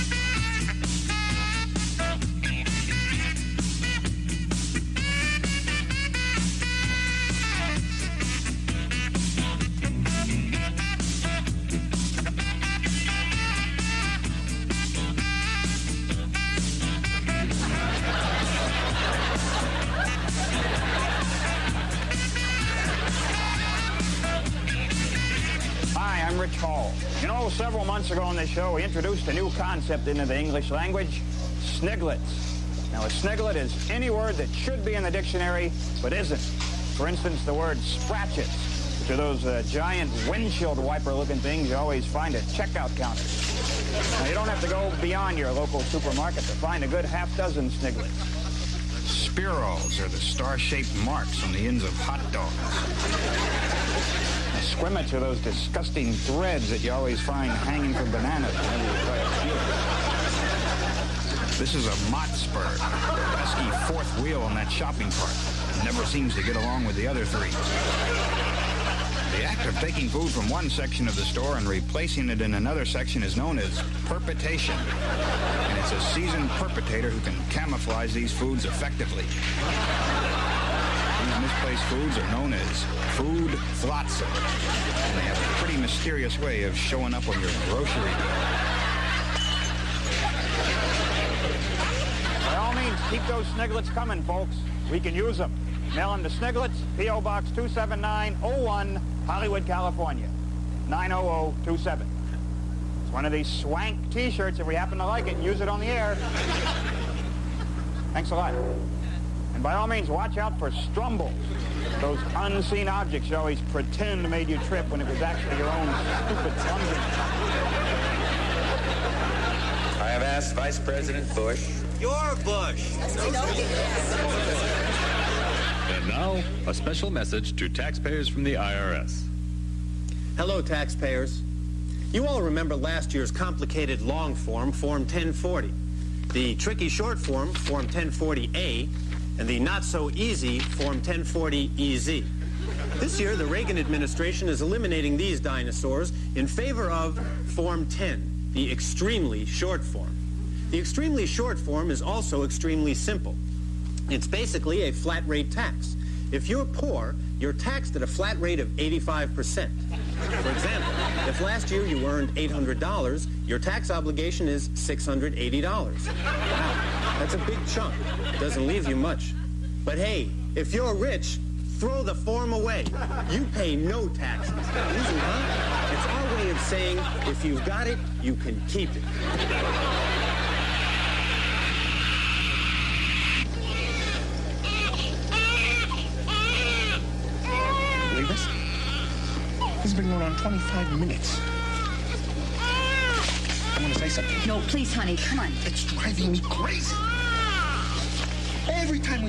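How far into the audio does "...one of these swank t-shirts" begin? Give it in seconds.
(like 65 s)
103 s.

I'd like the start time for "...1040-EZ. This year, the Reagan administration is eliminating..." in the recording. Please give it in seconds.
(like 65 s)
140 s.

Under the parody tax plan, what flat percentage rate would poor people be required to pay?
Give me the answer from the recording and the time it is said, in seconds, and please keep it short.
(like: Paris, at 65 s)
85%, at 158 s.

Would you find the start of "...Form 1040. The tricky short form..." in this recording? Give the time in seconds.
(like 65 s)
134 s.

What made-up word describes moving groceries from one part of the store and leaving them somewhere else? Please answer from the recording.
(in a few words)
perpetation.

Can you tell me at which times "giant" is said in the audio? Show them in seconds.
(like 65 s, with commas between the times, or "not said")
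39 s.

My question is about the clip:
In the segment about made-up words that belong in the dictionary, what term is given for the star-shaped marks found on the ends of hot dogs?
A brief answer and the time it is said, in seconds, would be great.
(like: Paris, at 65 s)
Spirals, at 49 s.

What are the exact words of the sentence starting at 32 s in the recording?
Now, a sniglet is any word that should be in the dictionary but isn't.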